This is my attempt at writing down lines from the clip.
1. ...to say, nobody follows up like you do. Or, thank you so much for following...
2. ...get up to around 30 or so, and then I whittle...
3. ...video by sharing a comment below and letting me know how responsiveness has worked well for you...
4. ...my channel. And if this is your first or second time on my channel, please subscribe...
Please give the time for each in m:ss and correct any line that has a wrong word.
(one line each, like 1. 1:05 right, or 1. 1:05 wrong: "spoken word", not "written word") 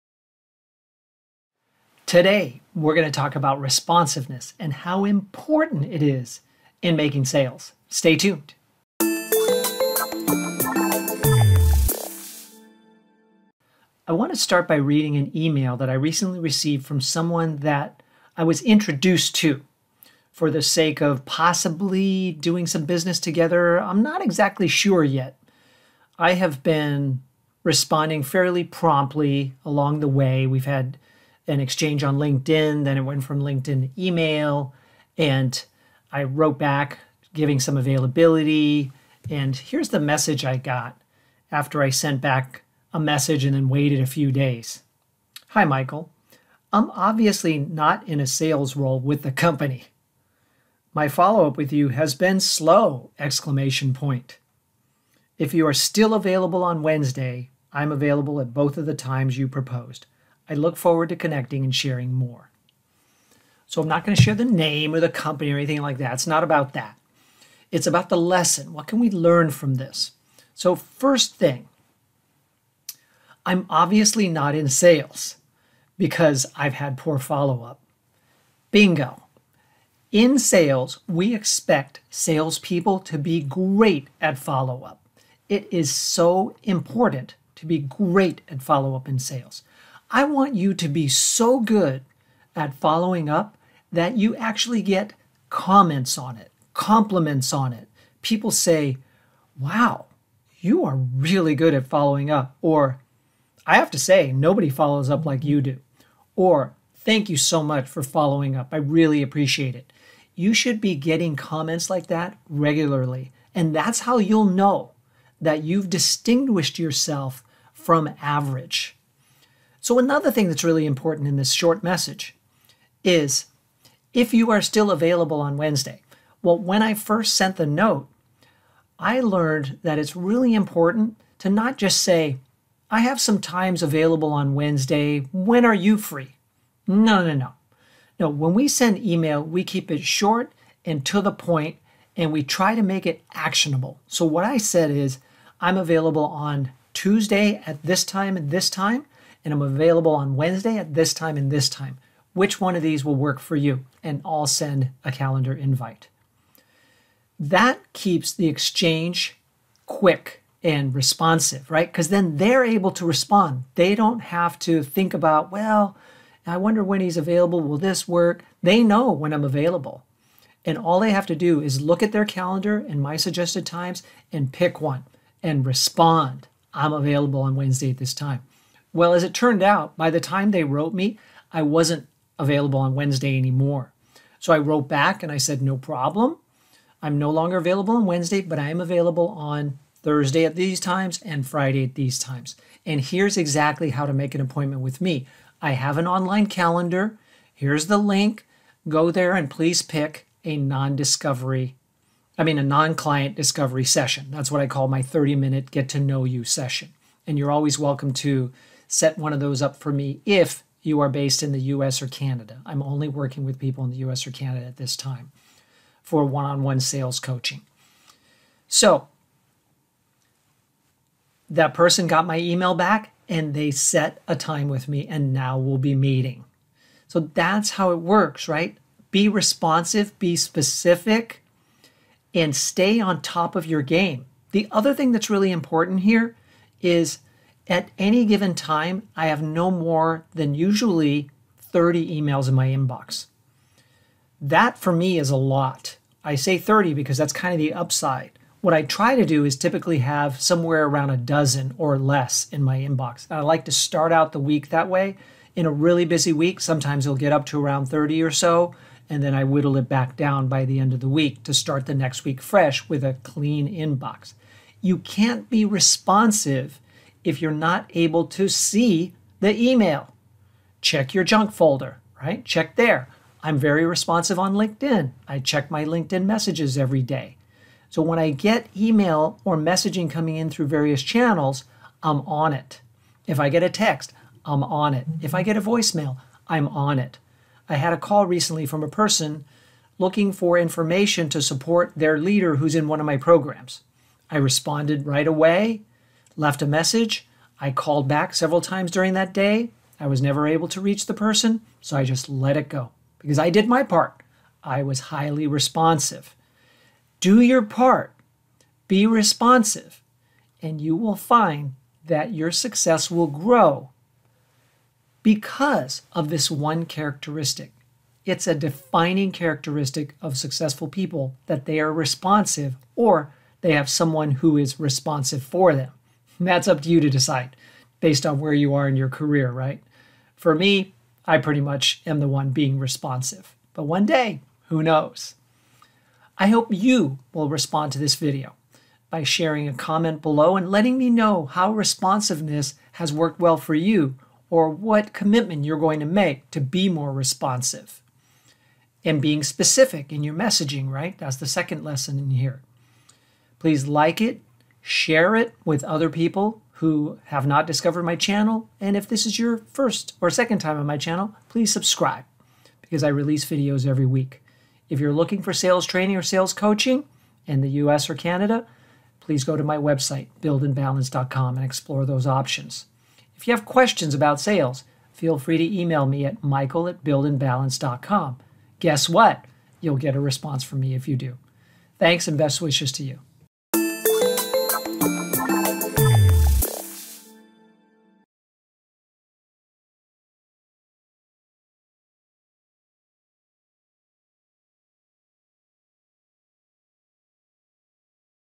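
1. 1:43 right
2. 4:17 right
3. 5:38 right
4. 5:58 right.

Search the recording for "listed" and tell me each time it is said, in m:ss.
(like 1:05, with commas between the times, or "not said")
not said.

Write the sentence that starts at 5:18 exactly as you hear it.
It's a defining characteristic of successful people that they are responsive or they have someone who is responsive for them.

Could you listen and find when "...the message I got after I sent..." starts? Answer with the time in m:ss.
0:39.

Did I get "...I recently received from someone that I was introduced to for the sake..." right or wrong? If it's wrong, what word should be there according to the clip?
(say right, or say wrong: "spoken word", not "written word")
right.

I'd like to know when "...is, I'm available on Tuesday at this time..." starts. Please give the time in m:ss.
2:24.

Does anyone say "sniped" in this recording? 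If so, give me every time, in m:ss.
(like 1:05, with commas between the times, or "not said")
not said.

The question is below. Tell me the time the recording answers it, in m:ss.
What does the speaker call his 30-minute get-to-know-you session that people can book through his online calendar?
3:22.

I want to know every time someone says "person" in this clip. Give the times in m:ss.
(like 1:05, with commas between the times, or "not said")
3:41, 4:48, 5:01.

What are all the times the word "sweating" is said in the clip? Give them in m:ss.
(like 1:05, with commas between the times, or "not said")
not said.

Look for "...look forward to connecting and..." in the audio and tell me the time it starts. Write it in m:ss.
1:00.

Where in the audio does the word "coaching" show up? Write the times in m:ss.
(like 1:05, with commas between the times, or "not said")
3:37, 6:06.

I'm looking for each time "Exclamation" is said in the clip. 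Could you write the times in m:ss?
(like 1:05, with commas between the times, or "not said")
0:53.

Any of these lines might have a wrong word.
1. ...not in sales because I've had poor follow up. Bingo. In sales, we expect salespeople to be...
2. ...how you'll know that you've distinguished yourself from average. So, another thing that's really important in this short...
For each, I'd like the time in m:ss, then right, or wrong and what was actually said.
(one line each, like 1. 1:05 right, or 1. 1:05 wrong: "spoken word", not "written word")
1. 1:14 right
2. 1:54 right.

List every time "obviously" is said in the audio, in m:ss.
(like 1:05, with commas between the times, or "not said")
0:46, 1:13.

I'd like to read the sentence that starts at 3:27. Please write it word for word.
And you're always welcome to set one of those up for me if you are based in the US or Canada.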